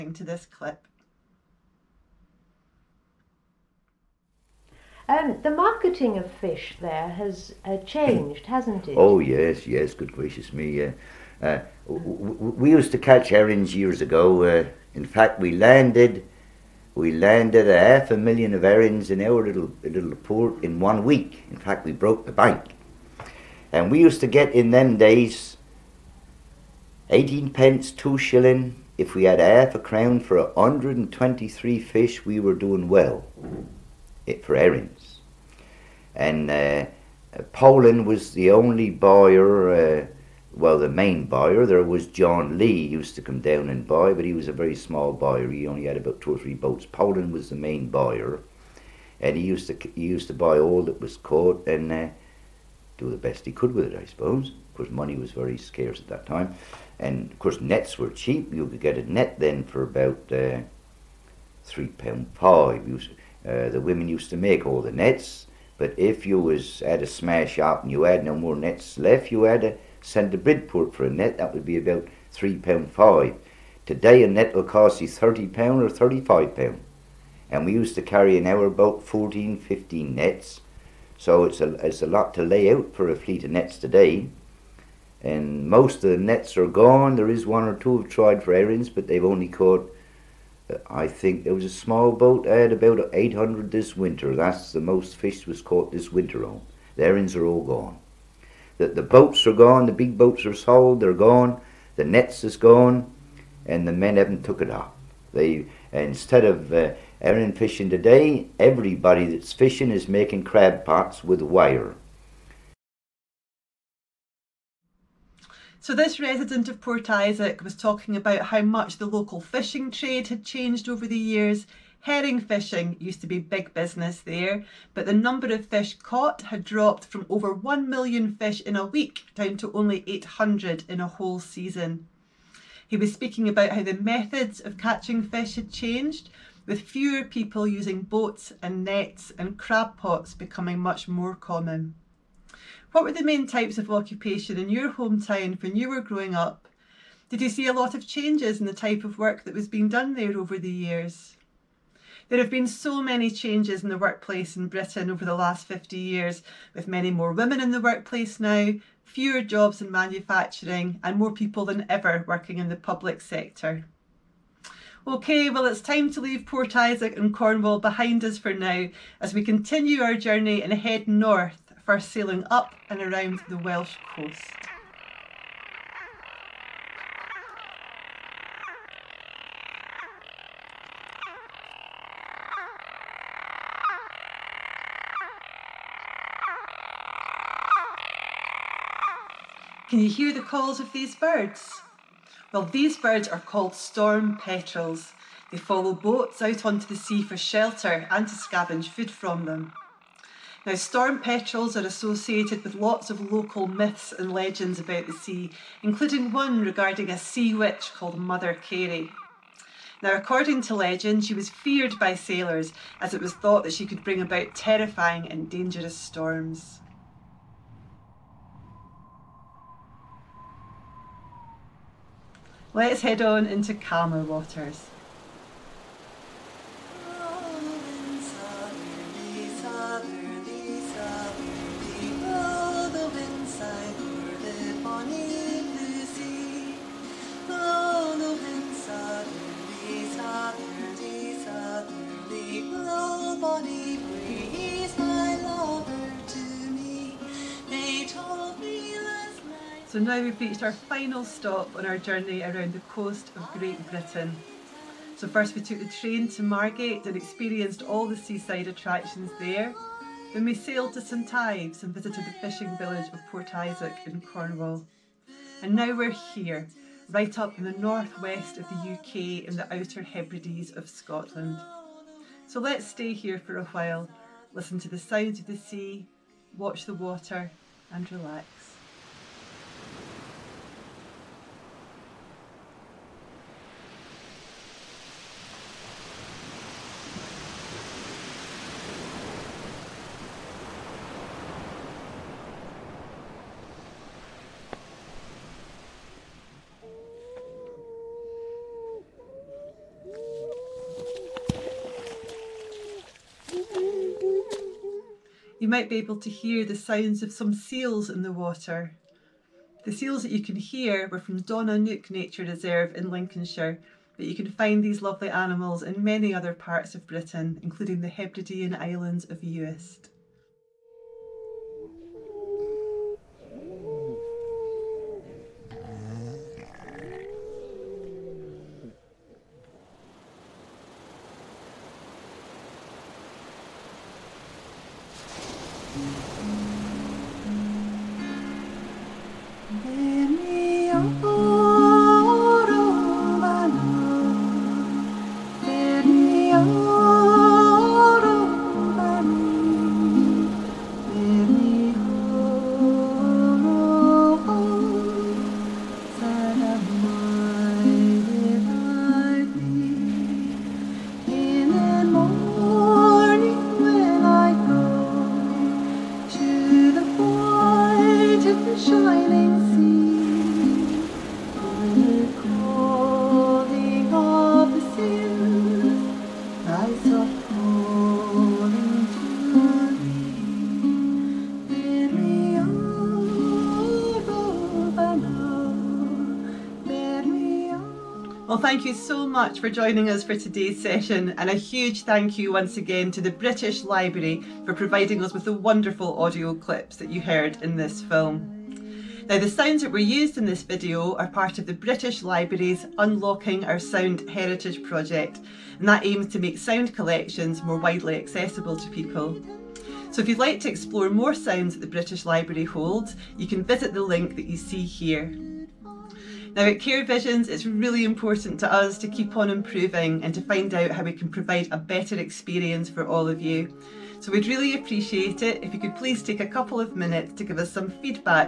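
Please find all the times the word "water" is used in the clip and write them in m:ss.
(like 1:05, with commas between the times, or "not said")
3:44, 4:36, 5:08.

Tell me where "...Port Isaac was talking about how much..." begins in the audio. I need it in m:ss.
1:56.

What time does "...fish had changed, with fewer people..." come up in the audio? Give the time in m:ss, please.
2:15.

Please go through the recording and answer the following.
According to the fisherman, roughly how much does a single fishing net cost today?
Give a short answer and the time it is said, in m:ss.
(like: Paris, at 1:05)
30 pounds, at 1:15.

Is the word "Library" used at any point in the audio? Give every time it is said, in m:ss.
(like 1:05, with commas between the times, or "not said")
6:33, 6:42, 6:52.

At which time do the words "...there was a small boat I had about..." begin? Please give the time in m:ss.
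1:31.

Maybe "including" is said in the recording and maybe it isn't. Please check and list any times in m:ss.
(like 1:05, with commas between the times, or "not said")
3:25, 5:17.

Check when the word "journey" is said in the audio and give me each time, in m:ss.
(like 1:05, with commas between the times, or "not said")
2:50, 4:11.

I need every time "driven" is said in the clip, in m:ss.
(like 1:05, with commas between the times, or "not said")
not said.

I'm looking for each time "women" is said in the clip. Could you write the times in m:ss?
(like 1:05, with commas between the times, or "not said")
1:03, 2:37.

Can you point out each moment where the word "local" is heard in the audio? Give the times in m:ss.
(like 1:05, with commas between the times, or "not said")
1:59, 3:23.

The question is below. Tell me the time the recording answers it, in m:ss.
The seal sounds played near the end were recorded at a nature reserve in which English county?
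5:13.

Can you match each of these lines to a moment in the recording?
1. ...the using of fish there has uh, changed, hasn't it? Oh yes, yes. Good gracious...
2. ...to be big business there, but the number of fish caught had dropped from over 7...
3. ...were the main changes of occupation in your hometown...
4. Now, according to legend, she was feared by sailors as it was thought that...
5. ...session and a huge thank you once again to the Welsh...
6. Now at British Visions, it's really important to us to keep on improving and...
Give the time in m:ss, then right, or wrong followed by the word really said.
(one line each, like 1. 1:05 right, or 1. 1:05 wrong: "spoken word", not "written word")
1. 0:05 wrong: "marketing", not "using"
2. 2:03 wrong: "1", not "7"
3. 2:23 wrong: "types", not "changes"
4. 3:30 right
5. 6:30 wrong: "British", not "Welsh"
6. 6:56 wrong: "Care", not "British".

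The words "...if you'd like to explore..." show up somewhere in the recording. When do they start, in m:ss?
6:50.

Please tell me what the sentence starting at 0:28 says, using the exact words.
If we had half a crown for 123 fish, we were doing well it, for herrings.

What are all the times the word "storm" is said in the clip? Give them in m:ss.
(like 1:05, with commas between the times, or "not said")
3:13, 3:20, 3:35.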